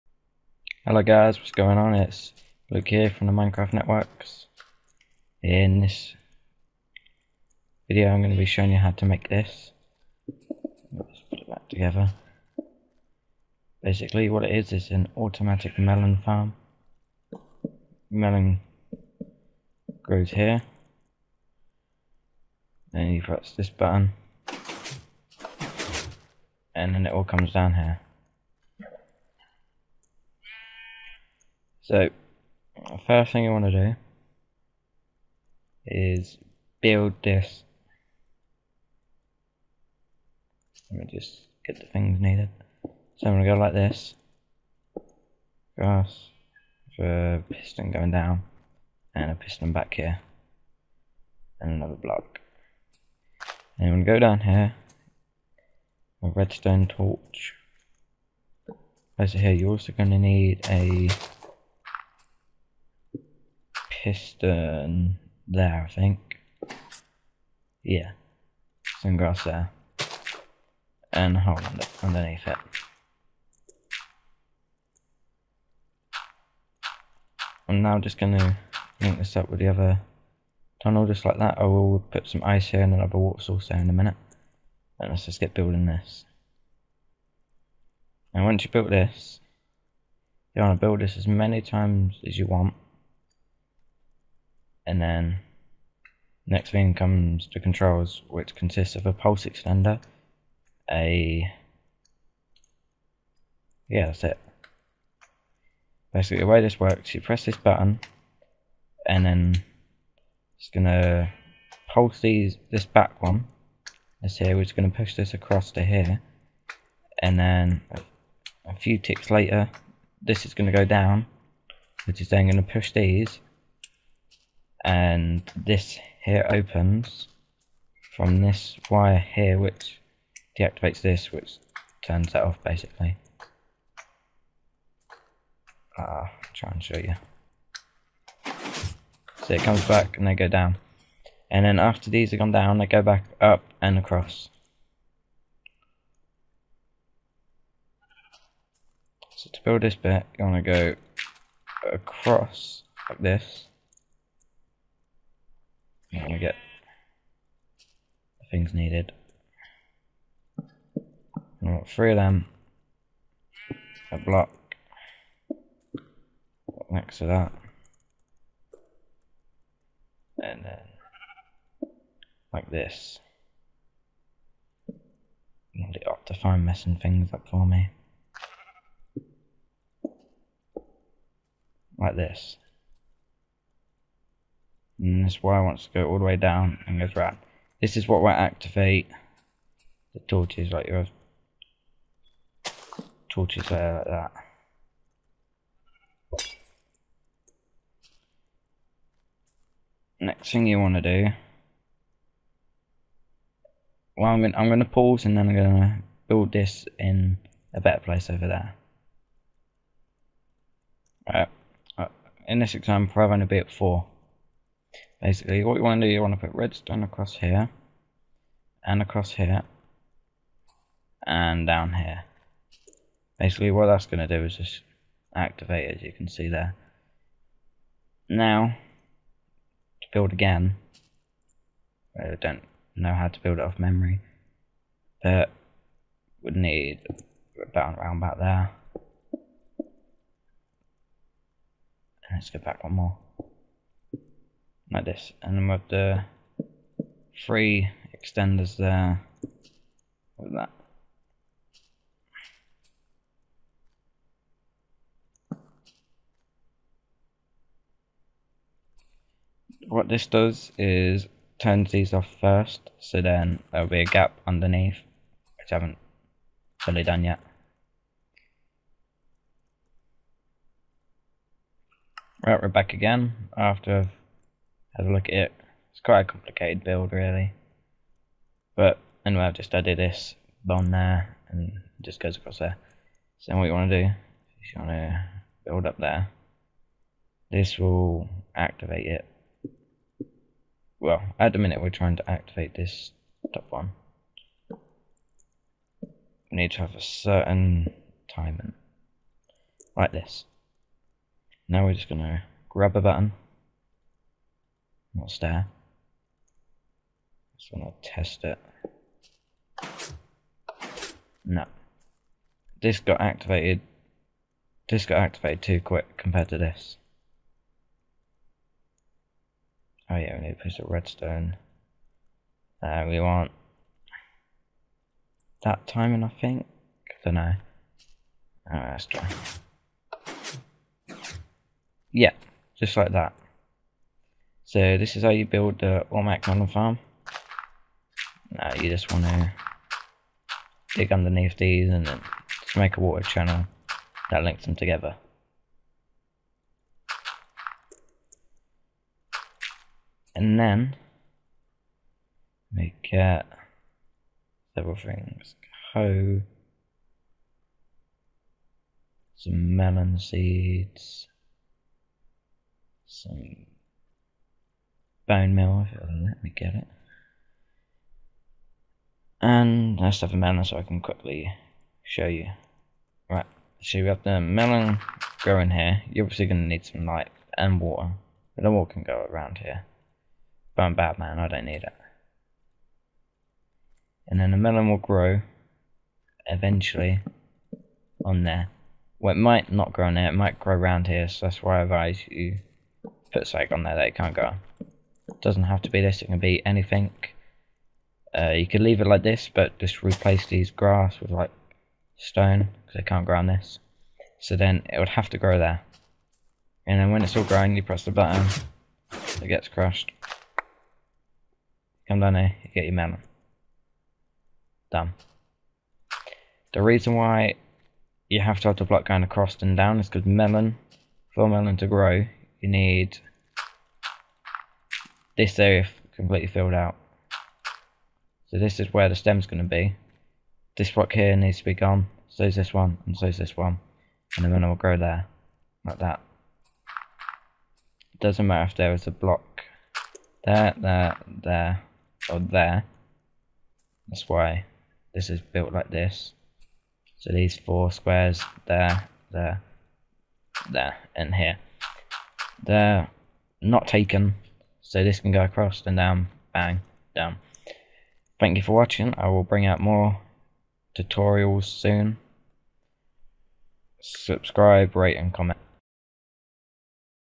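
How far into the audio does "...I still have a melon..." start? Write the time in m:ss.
6:09.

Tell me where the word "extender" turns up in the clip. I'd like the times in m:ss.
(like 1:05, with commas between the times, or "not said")
1:39, 4:08.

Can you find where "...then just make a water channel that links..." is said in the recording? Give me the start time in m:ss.
5:42.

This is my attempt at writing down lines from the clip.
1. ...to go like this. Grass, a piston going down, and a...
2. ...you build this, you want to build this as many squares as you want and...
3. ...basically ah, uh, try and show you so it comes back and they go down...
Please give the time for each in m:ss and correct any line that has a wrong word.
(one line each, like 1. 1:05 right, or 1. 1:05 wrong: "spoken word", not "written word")
1. 0:43 right
2. 1:28 wrong: "times", not "squares"
3. 2:12 right.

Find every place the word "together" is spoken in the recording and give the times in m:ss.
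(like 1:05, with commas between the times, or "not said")
0:11, 5:44.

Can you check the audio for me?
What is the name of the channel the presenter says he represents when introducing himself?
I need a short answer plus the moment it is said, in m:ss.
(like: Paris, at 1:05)
Minecraft Networks, at 0:03.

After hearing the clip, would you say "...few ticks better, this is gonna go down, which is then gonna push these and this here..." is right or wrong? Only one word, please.
wrong.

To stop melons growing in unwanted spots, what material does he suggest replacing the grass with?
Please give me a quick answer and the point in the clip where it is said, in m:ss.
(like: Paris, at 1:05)
Stone, at 6:42.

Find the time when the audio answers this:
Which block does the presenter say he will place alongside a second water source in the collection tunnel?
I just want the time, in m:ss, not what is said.
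1:22.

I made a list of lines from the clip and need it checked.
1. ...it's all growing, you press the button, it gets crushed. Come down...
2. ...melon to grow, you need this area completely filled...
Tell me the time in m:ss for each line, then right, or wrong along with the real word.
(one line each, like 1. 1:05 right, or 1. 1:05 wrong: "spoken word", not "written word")
1. 6:47 right
2. 7:01 right.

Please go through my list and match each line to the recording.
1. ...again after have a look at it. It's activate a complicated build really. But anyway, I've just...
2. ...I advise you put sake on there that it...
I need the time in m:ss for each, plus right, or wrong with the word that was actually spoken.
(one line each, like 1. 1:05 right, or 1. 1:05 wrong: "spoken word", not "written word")
1. 4:32 wrong: "quite", not "activate"
2. 6:31 right.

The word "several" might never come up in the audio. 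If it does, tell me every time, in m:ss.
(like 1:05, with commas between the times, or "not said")
5:54.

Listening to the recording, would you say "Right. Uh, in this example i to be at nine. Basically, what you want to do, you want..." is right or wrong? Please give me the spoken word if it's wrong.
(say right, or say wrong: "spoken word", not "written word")
wrong: "four", not "nine".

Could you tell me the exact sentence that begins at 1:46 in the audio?
Basically, the way this works, you press this button, and then it's gonna pulse these this back one.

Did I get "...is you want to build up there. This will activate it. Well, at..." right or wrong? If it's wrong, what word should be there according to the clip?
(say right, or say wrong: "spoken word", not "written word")
right.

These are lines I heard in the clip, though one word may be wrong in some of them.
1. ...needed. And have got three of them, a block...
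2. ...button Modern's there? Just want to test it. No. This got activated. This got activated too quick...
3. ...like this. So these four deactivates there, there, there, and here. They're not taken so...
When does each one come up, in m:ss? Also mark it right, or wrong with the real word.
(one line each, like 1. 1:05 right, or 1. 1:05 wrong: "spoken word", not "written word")
1. 2:38 right
2. 5:03 wrong: "What", not "Modern"
3. 7:25 wrong: "squares", not "deactivates".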